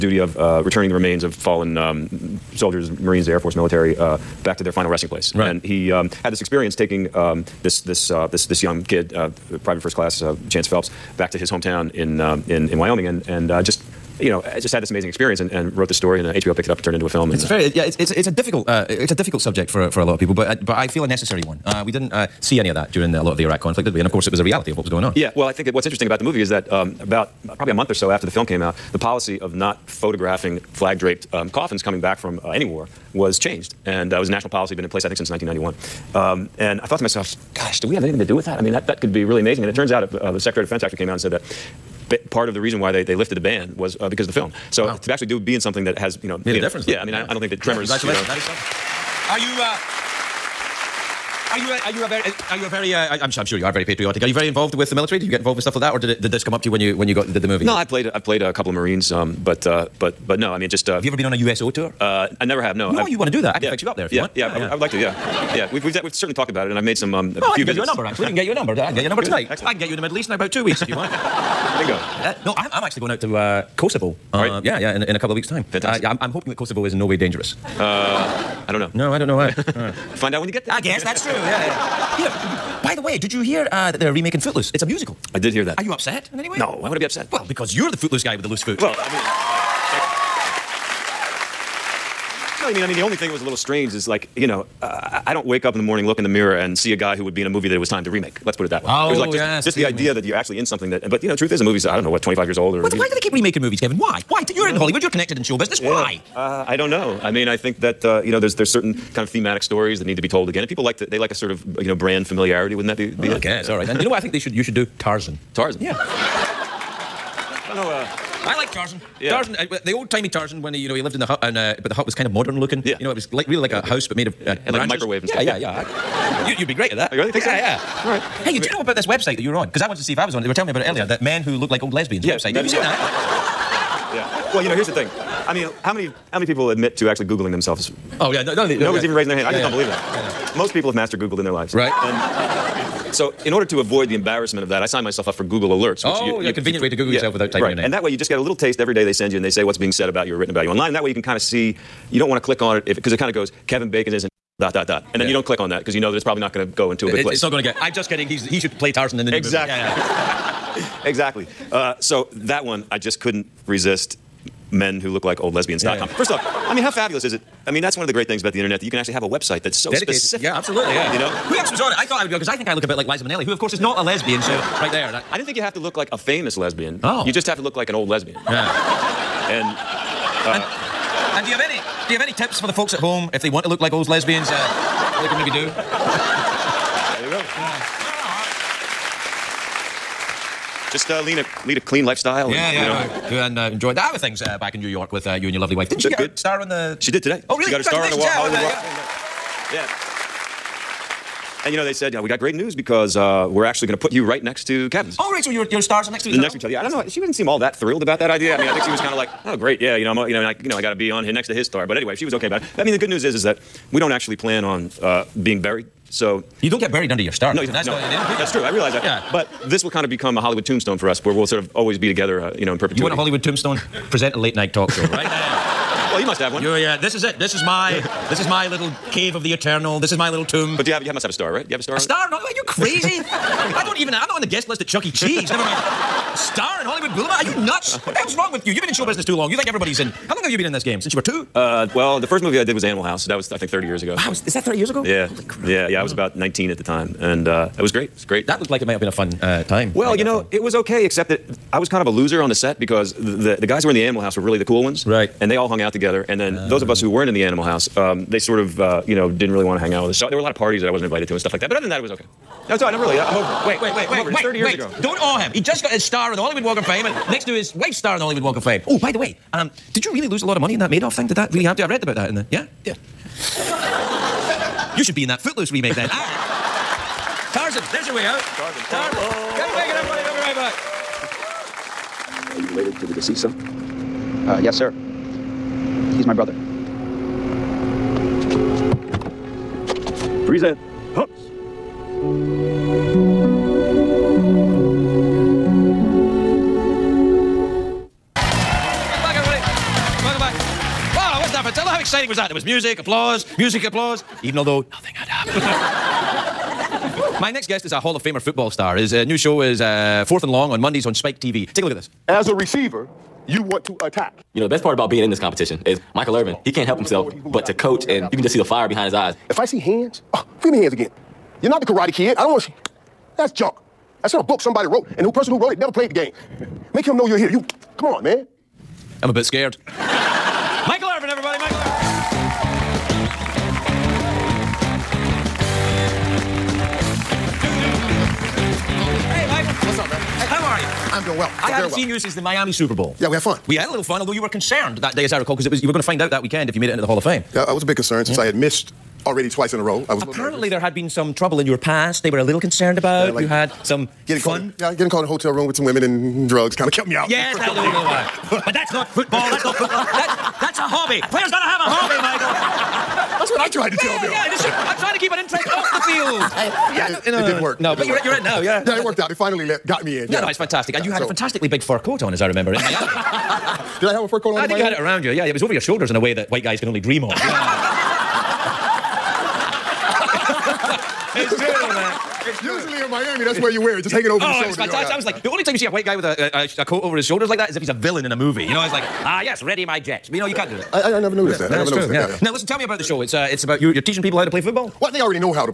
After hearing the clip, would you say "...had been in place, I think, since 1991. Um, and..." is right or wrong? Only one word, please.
right.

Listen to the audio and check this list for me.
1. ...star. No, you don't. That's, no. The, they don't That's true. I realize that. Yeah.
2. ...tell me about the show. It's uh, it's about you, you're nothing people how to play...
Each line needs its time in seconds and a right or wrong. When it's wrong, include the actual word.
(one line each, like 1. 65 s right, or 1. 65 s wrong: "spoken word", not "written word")
1. 217 s right
2. 392 s wrong: "teaching", not "nothing".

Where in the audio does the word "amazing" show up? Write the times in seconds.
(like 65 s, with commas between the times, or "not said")
14 s, 39 s.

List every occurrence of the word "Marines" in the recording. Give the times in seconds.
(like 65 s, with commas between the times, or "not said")
2 s, 58 s.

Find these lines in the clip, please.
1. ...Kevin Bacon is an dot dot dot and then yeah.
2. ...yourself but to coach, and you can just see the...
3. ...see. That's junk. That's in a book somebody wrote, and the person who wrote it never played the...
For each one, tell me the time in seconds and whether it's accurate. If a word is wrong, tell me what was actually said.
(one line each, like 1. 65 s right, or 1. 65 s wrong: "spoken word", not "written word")
1. 153 s right
2. 316 s wrong: "himself", not "yourself"
3. 322 s right.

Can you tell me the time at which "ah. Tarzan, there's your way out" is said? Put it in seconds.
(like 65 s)
276 s.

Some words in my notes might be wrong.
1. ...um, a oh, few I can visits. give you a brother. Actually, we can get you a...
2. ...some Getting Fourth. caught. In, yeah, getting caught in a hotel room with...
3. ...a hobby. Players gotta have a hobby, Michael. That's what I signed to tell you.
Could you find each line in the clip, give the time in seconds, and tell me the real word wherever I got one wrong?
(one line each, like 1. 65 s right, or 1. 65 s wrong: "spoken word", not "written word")
1. 67 s wrong: "number", not "brother"
2. 353 s wrong: "Fun", not "Fourth"
3. 360 s wrong: "tried", not "signed".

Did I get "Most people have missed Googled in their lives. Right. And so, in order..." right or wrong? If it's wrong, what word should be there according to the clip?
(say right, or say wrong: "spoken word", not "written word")
wrong: "mastered", not "missed".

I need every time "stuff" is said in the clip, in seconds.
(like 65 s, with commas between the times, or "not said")
55 s, 125 s, 261 s.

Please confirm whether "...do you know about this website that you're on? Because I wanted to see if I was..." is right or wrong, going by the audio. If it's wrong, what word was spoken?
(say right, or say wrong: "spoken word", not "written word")
right.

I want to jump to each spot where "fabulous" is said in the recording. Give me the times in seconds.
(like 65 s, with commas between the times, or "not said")
166 s.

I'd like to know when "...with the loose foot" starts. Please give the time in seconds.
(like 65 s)
88 s.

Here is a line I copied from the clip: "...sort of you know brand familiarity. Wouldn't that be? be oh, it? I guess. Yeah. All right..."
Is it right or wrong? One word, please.
right.